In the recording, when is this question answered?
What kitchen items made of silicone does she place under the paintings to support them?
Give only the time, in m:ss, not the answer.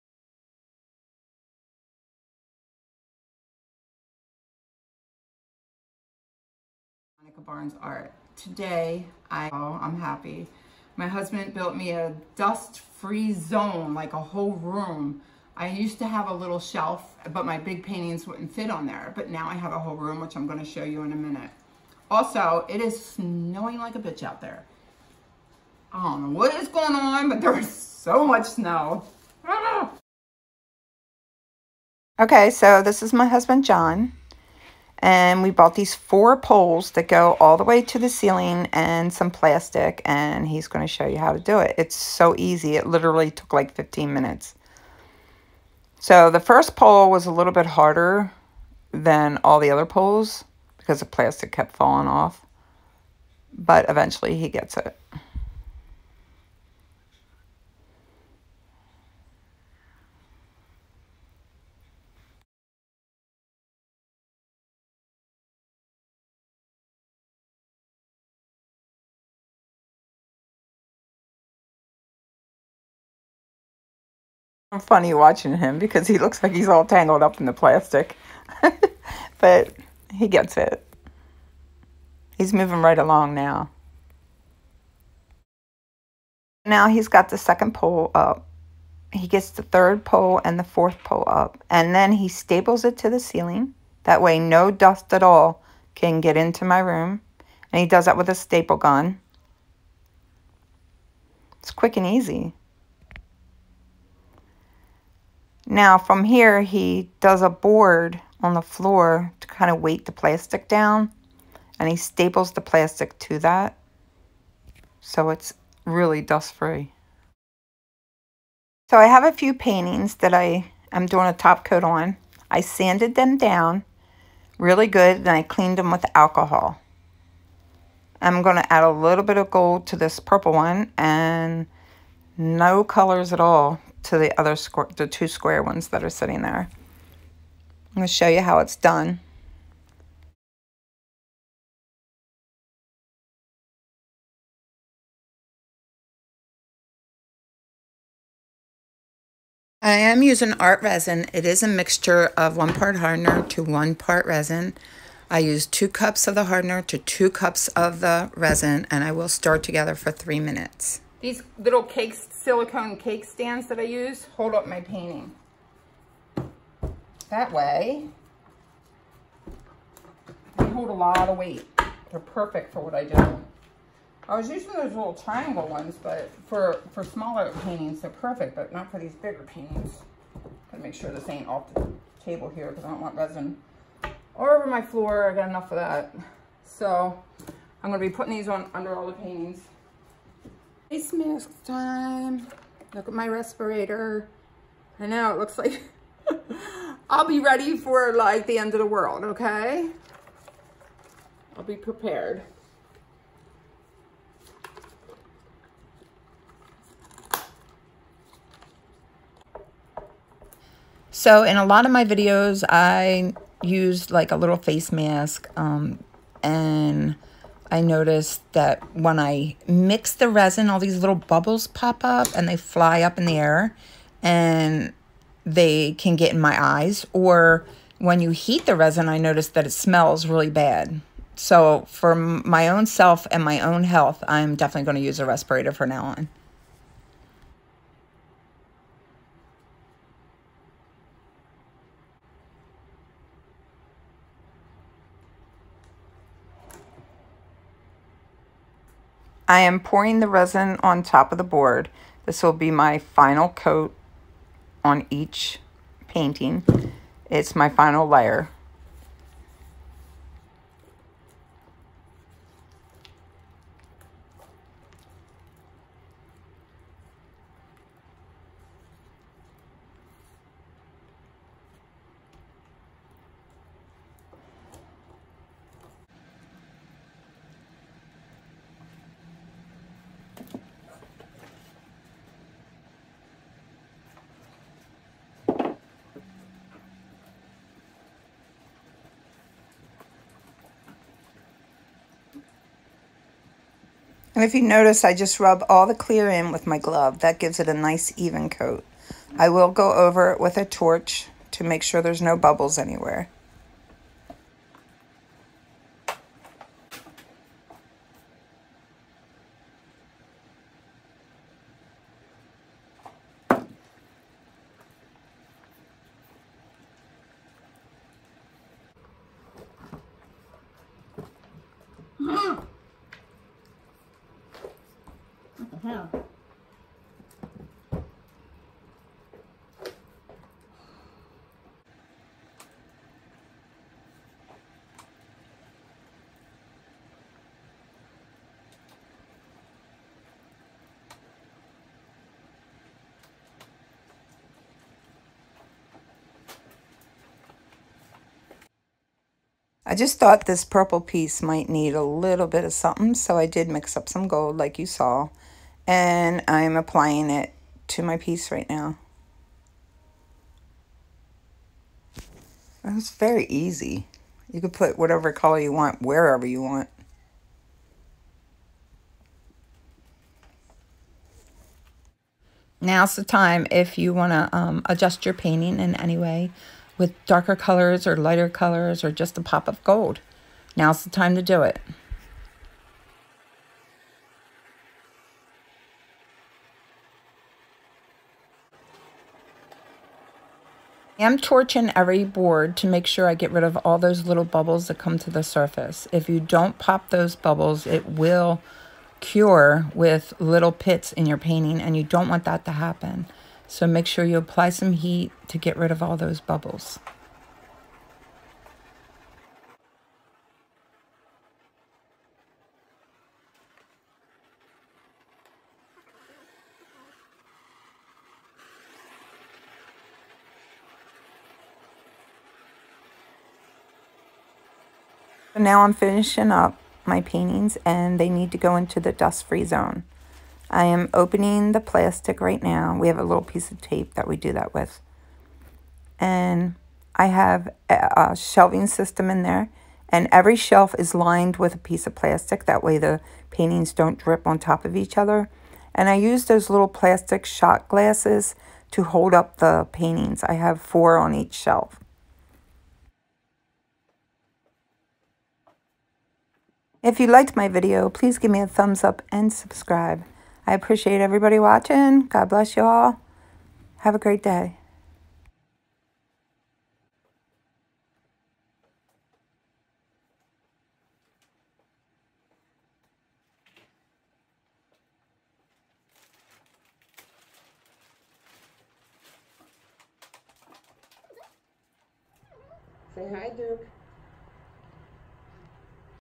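2:41.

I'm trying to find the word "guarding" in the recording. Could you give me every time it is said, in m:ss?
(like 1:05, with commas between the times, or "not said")
not said.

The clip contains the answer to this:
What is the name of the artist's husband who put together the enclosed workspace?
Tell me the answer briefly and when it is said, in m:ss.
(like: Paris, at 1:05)
John, at 0:33.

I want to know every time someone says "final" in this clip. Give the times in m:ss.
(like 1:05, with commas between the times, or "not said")
4:12, 4:17.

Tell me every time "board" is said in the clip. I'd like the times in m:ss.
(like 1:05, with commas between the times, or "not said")
1:47, 4:11, 6:32.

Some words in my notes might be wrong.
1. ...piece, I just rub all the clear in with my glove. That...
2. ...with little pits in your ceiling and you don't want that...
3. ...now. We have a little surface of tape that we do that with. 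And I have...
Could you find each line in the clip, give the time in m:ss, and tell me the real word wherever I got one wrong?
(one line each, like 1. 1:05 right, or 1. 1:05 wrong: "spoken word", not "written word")
1. 4:54 wrong: "notice", not "piece"
2. 6:39 wrong: "painting", not "ceiling"
3. 7:12 wrong: "piece", not "surface".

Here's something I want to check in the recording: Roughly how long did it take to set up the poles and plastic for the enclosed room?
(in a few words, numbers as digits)
15 minutes.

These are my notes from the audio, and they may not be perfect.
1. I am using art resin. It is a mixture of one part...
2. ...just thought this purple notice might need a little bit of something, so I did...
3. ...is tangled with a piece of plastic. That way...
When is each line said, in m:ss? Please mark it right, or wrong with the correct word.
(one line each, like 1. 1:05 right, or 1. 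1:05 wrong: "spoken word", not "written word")
1. 2:29 right
2. 5:49 wrong: "piece", not "notice"
3. 7:20 wrong: "lined", not "tangled".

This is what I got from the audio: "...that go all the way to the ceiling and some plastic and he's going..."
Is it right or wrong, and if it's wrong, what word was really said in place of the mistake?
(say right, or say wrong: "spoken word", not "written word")
right.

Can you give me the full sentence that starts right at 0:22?
Also, it is snowing like a bitch out there.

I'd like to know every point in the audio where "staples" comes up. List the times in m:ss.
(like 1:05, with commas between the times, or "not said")
1:32, 1:38, 1:51.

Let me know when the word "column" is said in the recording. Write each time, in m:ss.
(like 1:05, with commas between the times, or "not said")
not said.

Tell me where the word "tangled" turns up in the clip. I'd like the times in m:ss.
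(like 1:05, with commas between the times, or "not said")
1:16.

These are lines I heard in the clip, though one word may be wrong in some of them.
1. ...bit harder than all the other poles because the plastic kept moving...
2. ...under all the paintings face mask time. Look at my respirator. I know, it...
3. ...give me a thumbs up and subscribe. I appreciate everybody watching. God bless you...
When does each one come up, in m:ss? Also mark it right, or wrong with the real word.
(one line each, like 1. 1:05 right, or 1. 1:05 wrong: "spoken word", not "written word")
1. 0:47 wrong: "falling", not "moving"
2. 3:08 right
3. 7:38 right.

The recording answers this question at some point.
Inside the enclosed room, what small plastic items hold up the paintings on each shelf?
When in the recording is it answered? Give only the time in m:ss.
7:26.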